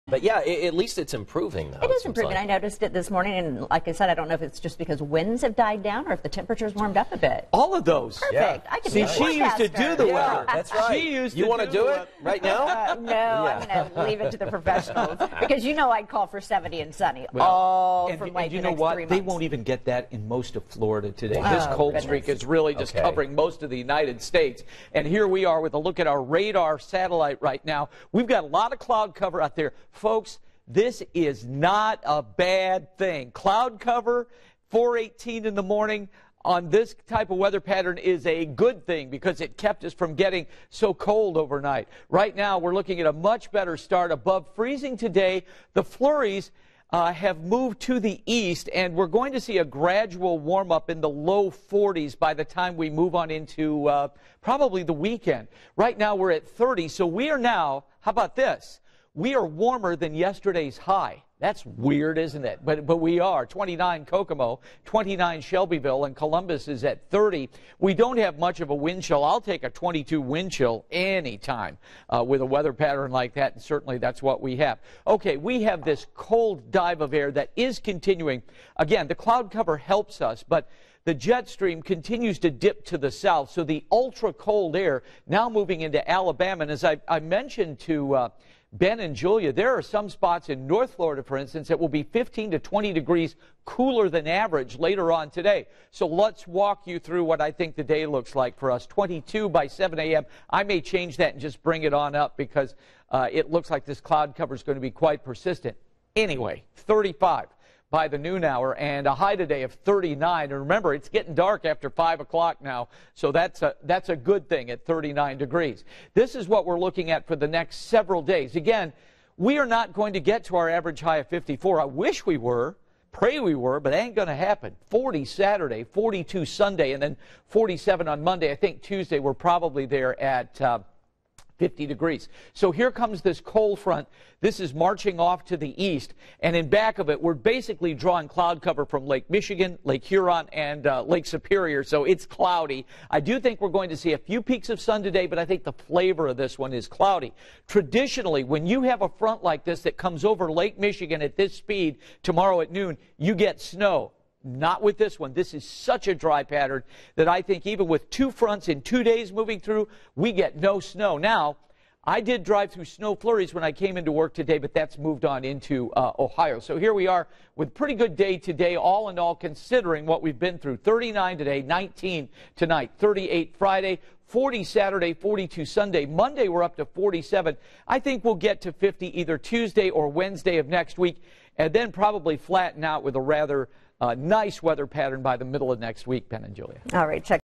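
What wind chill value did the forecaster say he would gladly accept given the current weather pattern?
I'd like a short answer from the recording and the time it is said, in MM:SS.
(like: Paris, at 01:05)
22, at 01:09.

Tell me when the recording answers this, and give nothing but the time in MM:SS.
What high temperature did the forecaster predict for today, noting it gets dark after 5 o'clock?
01:49.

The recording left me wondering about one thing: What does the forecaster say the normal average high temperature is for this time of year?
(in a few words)
54.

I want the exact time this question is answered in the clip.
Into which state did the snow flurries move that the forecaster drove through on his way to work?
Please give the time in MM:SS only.
02:46.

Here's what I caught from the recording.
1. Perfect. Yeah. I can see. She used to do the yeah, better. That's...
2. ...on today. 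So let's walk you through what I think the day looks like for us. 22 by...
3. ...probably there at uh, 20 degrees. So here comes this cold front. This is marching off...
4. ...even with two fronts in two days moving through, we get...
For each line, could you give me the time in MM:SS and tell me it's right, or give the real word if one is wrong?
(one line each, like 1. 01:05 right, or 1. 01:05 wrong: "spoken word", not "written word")
1. 00:08 wrong: "weather", not "better"
2. 01:35 right
3. 02:09 wrong: "50", not "20"
4. 02:37 right.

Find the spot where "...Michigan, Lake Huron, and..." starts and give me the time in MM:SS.
02:19.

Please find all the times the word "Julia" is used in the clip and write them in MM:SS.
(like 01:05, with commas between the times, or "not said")
01:29, 03:06.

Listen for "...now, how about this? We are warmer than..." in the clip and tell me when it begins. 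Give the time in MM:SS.
00:57.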